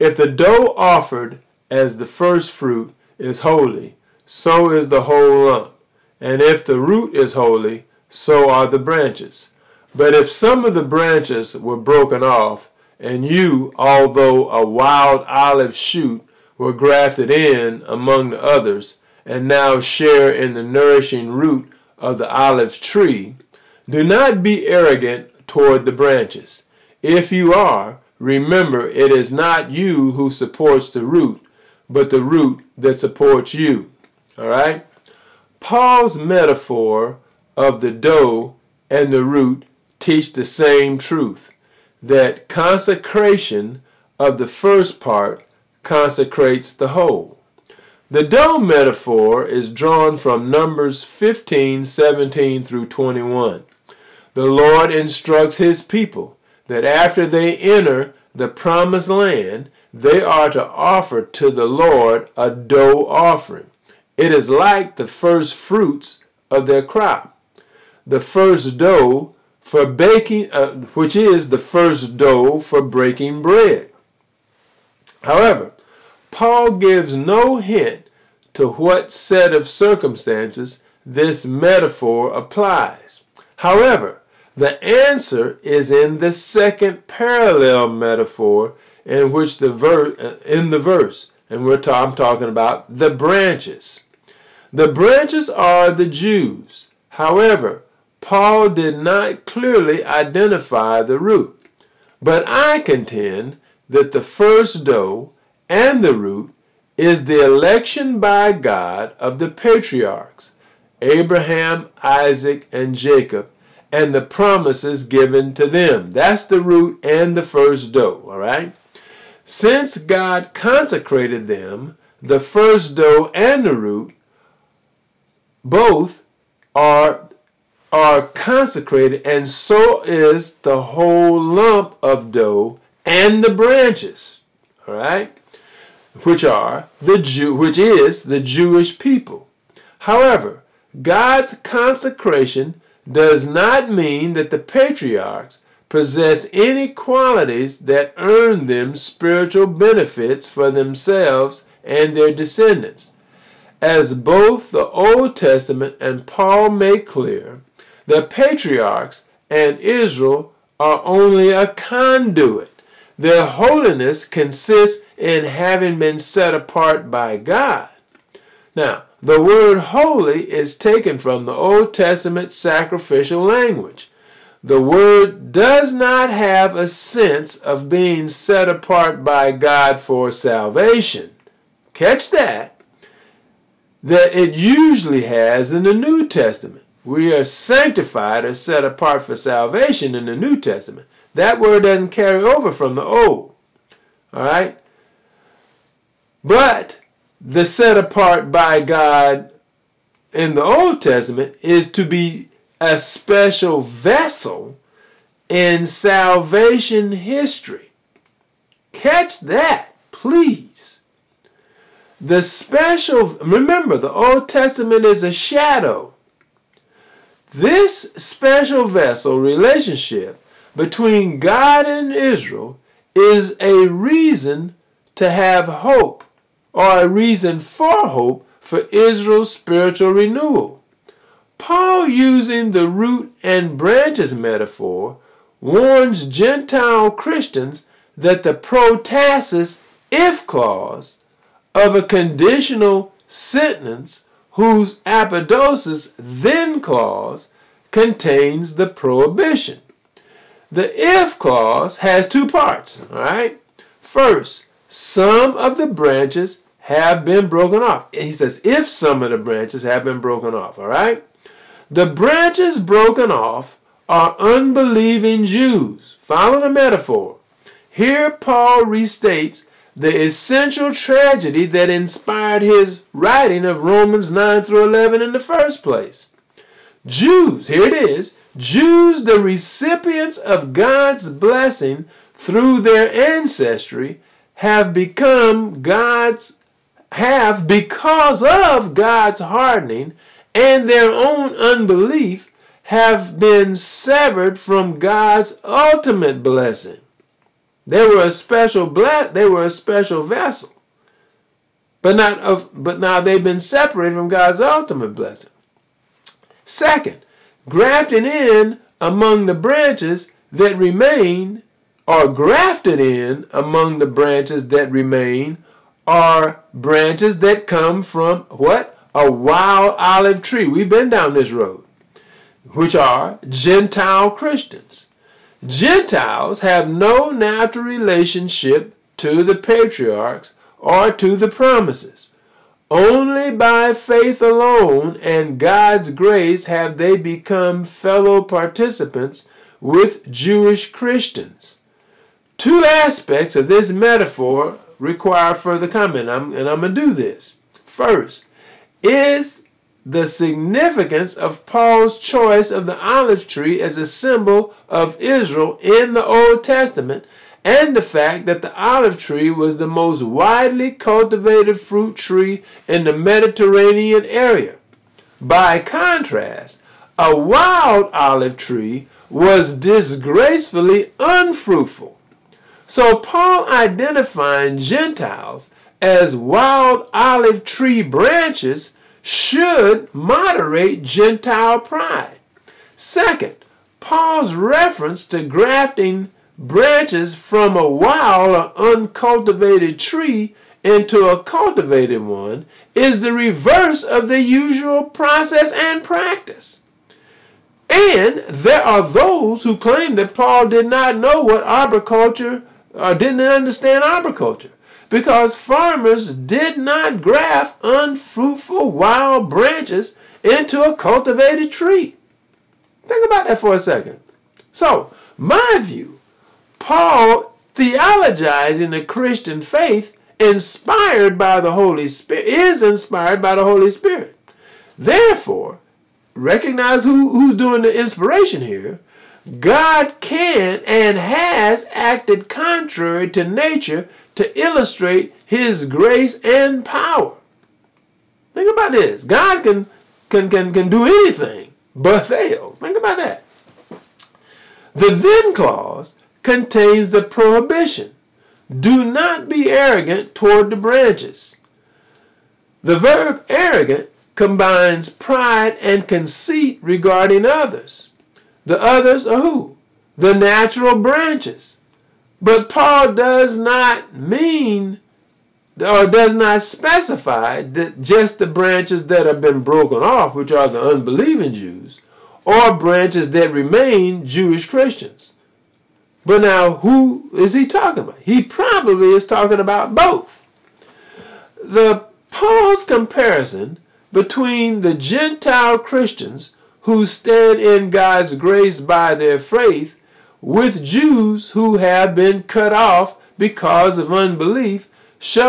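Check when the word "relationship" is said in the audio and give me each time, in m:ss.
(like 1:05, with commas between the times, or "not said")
3:39, 5:27.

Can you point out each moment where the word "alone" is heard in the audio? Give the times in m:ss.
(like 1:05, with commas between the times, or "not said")
5:34.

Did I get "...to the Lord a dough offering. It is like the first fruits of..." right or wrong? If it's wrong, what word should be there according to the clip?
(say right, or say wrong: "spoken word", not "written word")
right.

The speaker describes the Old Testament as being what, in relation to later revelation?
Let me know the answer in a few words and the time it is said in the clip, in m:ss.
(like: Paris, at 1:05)
A shadow, at 3:35.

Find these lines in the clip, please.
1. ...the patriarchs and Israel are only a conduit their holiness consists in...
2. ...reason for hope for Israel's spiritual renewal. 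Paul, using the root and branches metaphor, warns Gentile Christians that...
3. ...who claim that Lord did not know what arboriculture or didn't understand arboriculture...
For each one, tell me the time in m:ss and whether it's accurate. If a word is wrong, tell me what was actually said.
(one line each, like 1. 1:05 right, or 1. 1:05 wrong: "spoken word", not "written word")
1. 2:38 right
2. 3:47 right
3. 6:39 wrong: "Paul", not "Lord".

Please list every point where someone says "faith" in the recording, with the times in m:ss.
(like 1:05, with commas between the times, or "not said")
5:33, 6:59, 8:09.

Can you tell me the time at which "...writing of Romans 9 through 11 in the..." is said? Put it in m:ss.
4:33.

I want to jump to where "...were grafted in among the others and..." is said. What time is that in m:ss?
0:16.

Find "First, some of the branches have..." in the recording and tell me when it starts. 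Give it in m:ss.
4:14.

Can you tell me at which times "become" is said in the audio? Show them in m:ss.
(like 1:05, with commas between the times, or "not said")
4:44, 5:37.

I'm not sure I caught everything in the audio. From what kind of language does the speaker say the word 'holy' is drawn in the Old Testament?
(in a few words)
Sacrificial language.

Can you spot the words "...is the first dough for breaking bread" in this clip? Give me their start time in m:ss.
1:11.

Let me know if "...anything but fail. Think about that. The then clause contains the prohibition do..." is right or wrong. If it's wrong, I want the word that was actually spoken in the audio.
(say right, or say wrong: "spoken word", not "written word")
right.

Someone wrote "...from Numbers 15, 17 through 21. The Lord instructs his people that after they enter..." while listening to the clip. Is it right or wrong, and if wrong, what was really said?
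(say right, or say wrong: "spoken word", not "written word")
right.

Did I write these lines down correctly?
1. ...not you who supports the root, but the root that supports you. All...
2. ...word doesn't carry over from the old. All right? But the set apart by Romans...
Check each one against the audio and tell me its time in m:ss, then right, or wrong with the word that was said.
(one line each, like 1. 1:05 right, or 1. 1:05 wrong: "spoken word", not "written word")
1. 0:29 right
2. 3:11 wrong: "God", not "Romans".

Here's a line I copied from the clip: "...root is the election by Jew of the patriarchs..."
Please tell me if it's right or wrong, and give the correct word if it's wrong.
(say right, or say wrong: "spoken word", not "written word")
wrong: "God", not "Jew".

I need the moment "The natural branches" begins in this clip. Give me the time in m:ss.
7:40.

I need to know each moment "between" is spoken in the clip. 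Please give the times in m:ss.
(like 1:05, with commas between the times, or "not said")
3:40, 8:04.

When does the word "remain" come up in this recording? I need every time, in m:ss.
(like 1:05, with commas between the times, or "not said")
5:10, 5:14, 7:53.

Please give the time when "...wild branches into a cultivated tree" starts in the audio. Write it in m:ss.
6:48.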